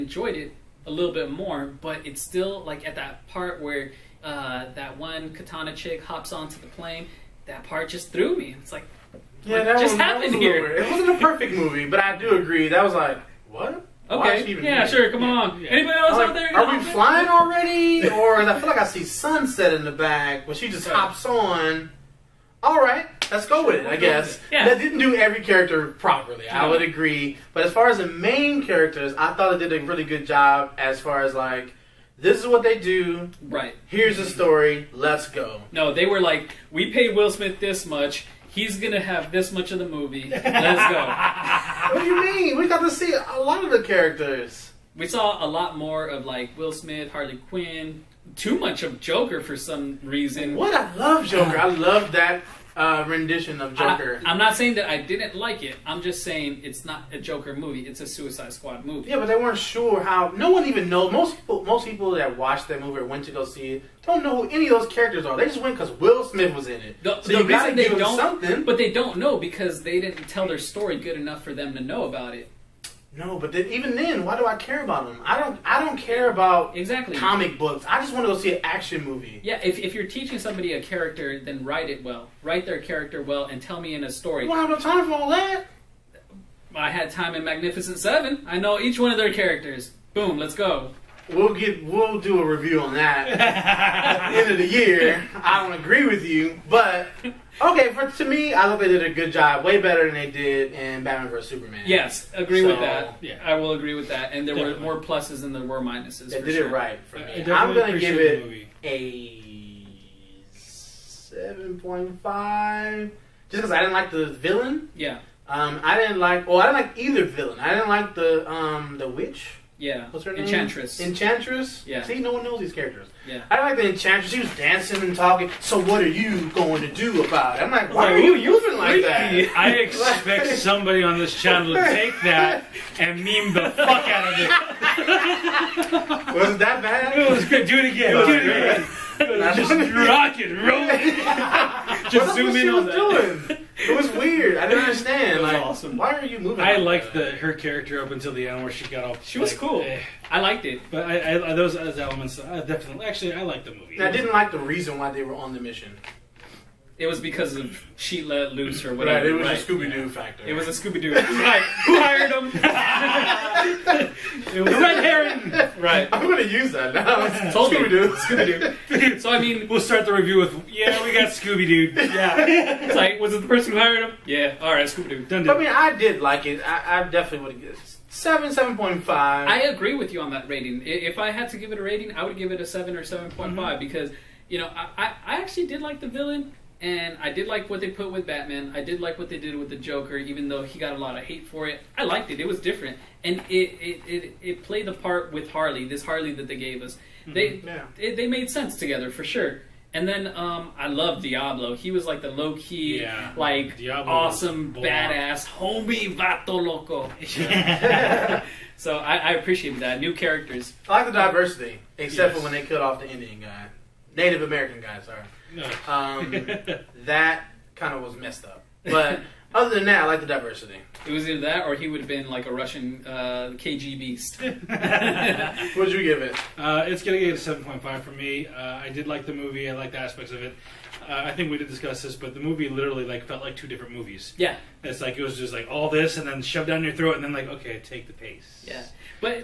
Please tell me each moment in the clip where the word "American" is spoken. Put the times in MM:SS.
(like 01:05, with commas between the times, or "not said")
03:34.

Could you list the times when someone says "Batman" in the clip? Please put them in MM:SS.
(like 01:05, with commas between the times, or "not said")
01:41, 03:08.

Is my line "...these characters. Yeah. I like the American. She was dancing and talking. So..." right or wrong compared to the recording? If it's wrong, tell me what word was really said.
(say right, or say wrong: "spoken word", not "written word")
wrong: "Enchantress", not "American".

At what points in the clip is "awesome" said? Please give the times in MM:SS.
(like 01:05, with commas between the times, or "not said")
02:25, 03:24.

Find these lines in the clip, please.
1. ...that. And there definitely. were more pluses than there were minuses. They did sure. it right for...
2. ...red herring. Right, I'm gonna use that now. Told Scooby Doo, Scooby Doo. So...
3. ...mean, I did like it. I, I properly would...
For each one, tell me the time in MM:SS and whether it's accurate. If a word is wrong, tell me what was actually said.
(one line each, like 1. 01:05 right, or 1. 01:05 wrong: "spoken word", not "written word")
1. 01:44 right
2. 02:44 right
3. 02:55 wrong: "definitely", not "properly".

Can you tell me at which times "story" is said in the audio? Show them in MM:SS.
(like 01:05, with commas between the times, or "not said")
00:34, 01:10, 01:24.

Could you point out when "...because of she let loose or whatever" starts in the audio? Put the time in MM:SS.
02:37.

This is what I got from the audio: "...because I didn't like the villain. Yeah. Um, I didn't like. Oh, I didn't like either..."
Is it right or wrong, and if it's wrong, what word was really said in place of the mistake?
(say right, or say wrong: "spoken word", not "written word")
right.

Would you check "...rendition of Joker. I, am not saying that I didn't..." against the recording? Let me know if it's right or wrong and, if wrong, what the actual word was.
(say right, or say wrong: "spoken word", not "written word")
right.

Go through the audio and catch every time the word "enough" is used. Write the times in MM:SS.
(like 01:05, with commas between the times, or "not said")
01:11.